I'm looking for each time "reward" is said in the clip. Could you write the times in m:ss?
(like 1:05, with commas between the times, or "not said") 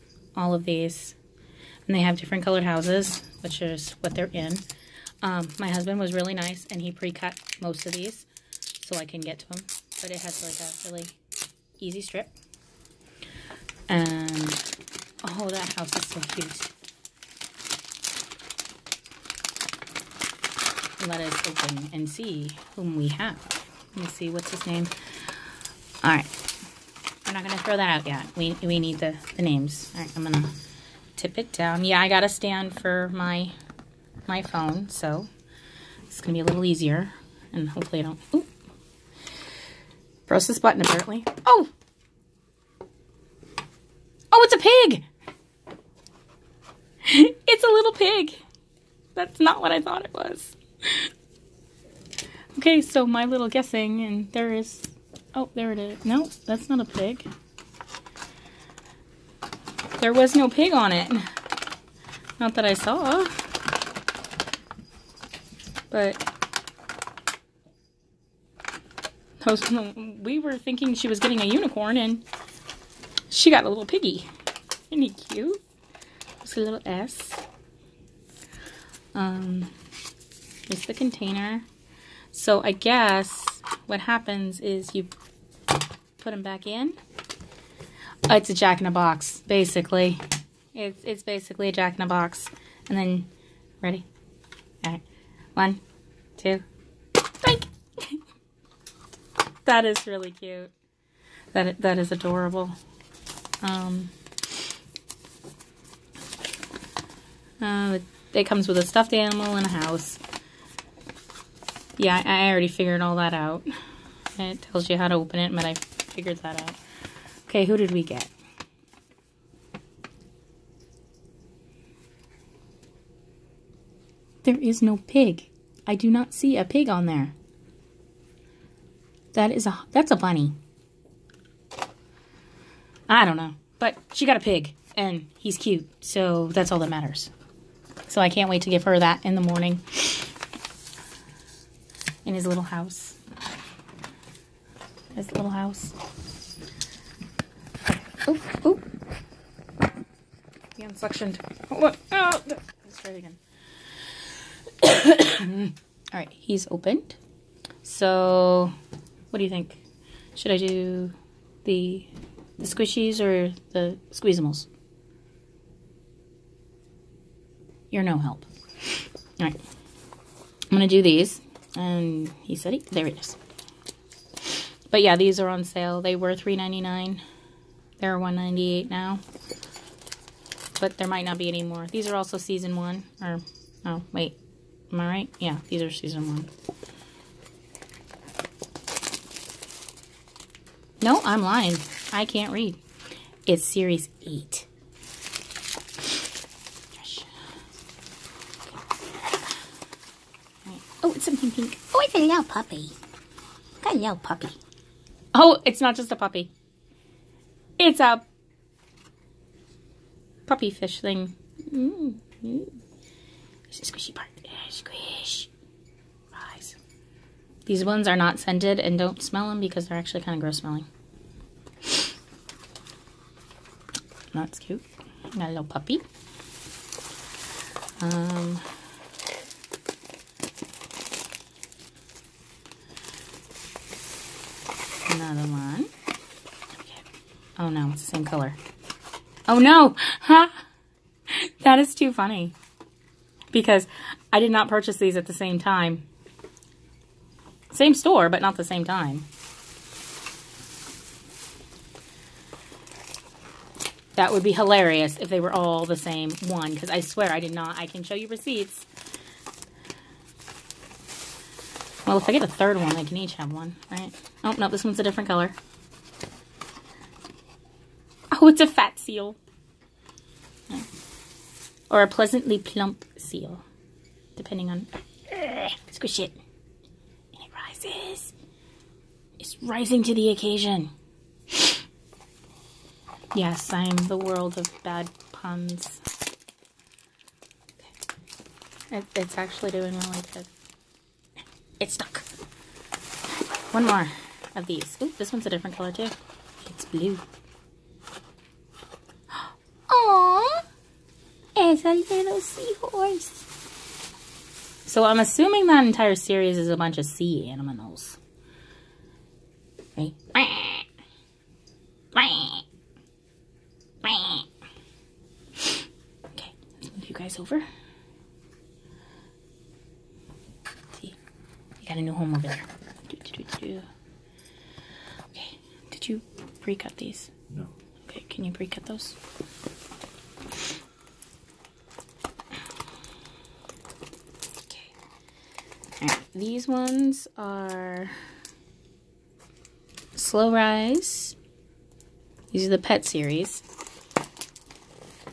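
not said.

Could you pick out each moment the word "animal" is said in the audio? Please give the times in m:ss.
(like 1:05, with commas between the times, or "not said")
1:49, 5:07.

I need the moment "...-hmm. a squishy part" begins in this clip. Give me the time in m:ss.
3:32.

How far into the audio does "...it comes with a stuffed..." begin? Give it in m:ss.
1:48.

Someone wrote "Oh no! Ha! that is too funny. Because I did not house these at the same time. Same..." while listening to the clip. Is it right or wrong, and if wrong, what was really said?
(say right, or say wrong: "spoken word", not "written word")
wrong: "purchase", not "house".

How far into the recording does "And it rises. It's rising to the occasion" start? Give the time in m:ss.
4:37.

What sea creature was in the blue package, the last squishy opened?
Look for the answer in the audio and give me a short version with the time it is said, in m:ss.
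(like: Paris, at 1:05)
seahorse, at 5:01.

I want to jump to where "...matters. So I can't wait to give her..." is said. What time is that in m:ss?
2:16.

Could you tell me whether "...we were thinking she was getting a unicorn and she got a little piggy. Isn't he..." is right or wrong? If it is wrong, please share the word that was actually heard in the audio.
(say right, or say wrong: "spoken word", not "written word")
right.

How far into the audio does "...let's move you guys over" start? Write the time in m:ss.
5:16.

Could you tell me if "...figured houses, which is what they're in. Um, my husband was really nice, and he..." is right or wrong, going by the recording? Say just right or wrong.
wrong.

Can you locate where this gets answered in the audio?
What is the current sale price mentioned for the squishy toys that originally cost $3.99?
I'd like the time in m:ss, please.
2:58.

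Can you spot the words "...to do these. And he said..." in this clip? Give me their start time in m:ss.
2:50.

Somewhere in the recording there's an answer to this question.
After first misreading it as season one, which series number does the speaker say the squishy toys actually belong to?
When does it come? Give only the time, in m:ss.
3:13.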